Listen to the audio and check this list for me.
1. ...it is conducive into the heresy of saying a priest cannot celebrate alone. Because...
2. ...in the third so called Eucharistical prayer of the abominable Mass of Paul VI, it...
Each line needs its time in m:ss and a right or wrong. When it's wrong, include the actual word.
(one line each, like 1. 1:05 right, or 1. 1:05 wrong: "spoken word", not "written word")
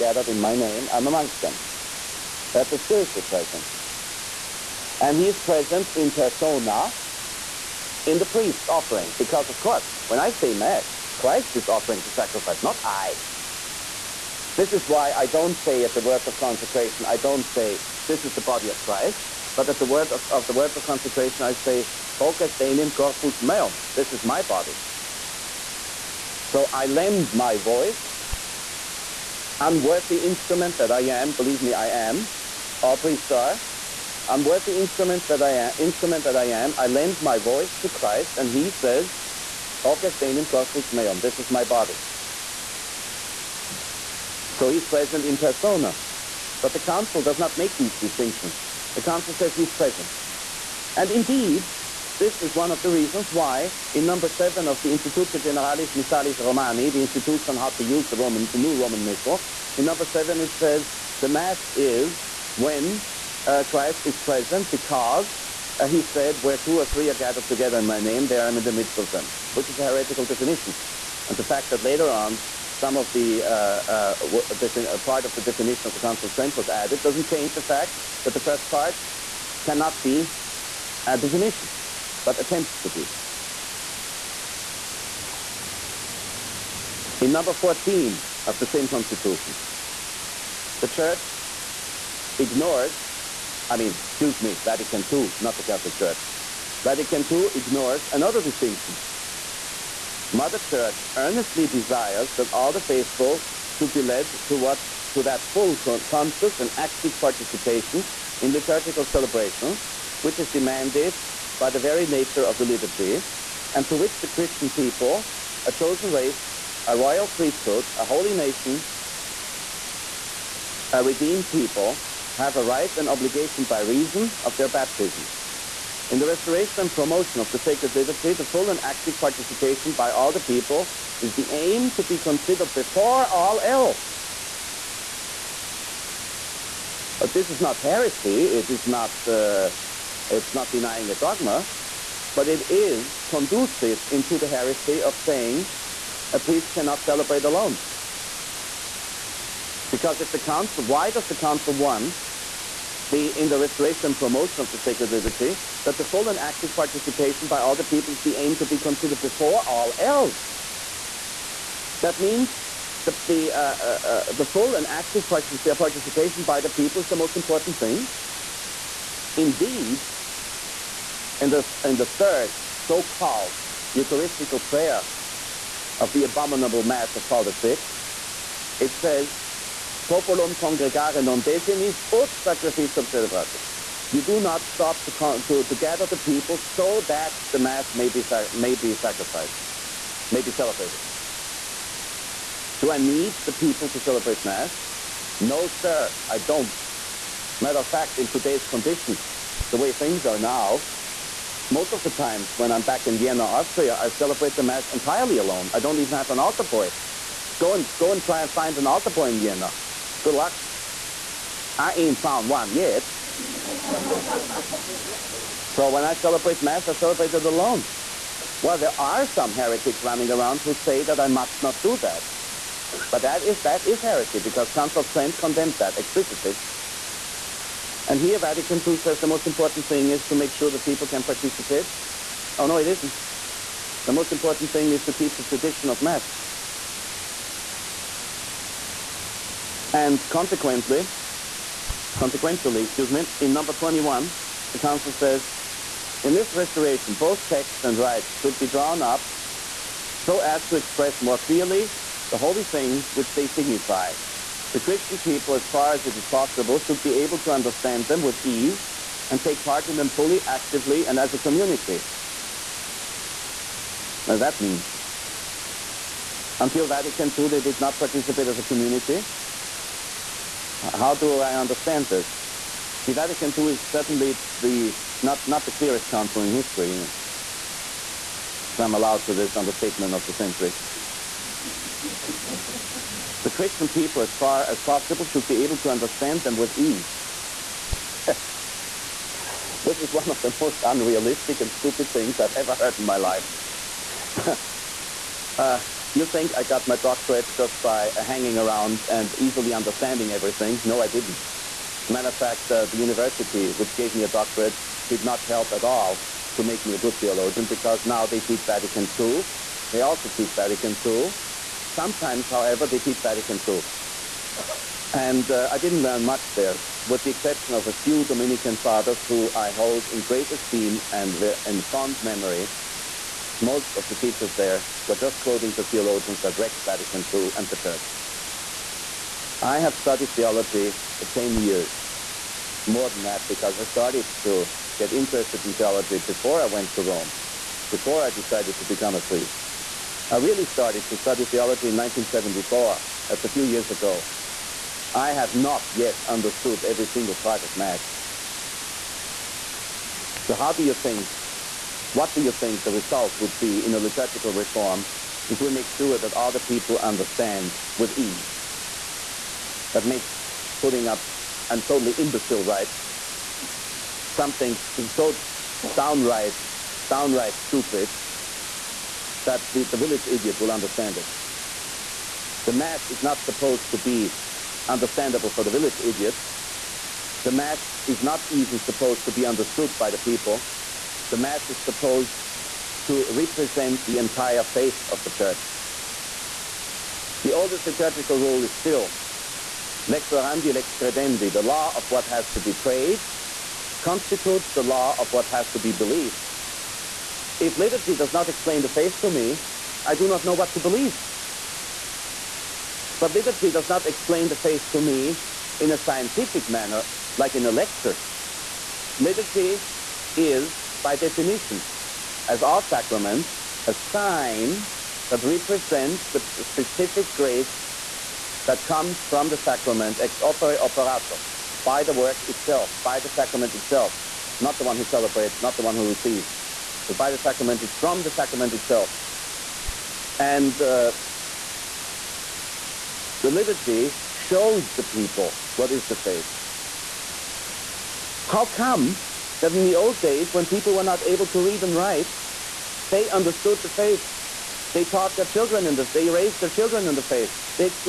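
1. 2:22 right
2. 2:51 right.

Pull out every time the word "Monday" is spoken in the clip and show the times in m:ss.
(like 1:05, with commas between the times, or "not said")
not said.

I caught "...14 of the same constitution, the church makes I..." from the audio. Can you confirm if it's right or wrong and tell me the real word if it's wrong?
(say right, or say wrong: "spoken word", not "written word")
wrong: "ignores", not "makes".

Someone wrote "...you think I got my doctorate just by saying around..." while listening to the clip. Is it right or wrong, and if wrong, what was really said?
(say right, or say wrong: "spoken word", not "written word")
wrong: "hanging", not "saying".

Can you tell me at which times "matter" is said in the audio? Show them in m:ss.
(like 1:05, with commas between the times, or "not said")
3:17, 5:02.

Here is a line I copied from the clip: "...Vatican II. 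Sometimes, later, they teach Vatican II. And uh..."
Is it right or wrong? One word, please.
wrong.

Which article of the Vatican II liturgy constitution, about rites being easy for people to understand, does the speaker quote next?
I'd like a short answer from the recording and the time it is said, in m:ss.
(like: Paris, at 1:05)
21, at 4:03.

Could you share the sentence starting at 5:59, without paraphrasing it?
That makes putting up an totally imbecile, right?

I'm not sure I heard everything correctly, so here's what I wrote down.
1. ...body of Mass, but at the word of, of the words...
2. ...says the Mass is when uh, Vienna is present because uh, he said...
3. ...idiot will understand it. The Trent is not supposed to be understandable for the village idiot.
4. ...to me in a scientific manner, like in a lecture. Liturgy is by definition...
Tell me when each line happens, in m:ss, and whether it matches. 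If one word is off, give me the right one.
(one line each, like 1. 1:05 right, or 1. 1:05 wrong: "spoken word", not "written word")
1. 0:18 wrong: "Christ", not "Mass"
2. 1:00 wrong: "Christ", not "Vienna"
3. 6:10 wrong: "Mass", not "Trent"
4. 6:44 right.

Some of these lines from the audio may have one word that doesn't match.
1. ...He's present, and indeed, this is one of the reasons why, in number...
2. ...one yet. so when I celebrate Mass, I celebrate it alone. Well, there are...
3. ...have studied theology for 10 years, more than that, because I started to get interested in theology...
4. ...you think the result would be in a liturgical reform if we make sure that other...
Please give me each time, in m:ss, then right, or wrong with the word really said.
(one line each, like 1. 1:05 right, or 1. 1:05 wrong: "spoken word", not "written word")
1. 0:49 right
2. 3:32 right
3. 5:29 right
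4. 5:52 right.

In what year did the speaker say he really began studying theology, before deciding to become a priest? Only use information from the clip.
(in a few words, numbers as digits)
1974.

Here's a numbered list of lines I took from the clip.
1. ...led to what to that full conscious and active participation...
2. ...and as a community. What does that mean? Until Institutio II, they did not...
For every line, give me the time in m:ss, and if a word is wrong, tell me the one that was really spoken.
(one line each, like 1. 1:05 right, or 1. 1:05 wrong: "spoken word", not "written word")
1. 1:44 right
2. 4:21 wrong: "Vatican", not "Institutio".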